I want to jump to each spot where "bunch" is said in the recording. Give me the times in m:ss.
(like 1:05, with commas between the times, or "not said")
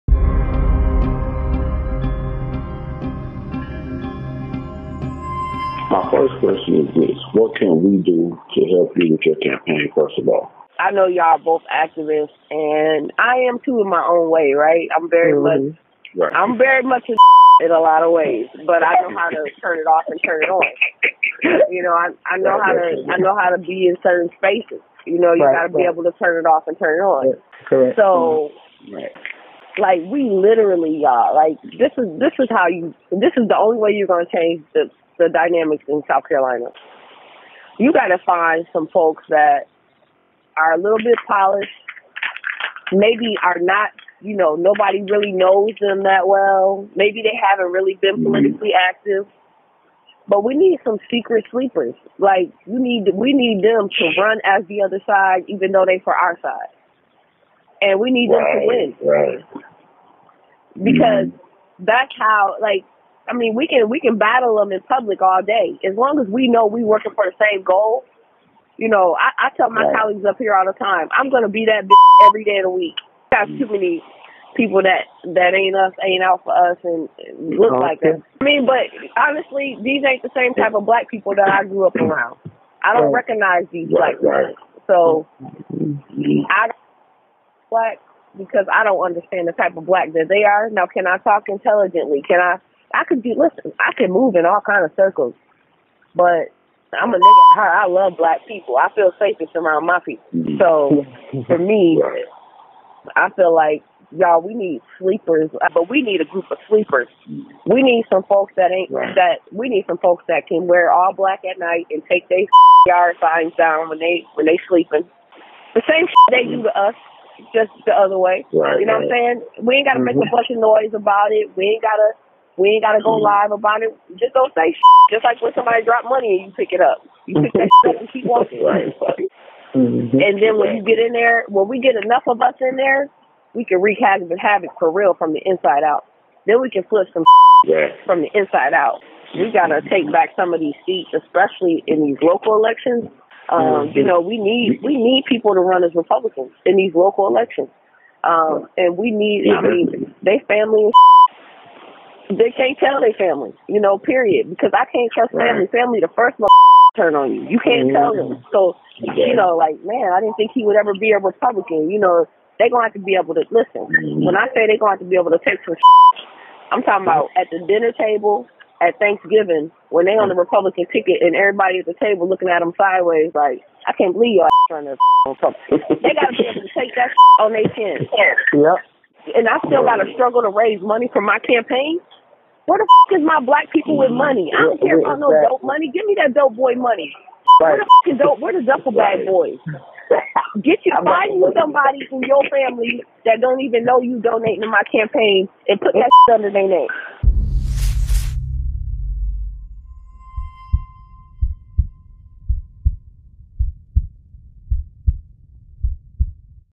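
2:00.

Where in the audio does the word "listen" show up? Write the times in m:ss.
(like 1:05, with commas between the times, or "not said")
1:33, 2:43.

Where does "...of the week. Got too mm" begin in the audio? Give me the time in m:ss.
1:12.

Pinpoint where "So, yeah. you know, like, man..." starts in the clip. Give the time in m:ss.
2:38.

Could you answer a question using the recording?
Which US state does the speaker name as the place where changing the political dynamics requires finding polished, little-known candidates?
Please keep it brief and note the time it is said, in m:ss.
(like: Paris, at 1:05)
South Carolina, at 0:36.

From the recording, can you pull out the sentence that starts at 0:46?
Maybe they haven't really been mm-hmm.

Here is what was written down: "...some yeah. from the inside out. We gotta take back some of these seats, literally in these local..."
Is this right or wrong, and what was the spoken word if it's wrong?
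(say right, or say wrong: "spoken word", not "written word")
wrong: "especially", not "literally".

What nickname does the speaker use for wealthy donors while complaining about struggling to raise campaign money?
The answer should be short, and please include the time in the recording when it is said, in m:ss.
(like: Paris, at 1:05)
Duffel bag boys, at 3:08.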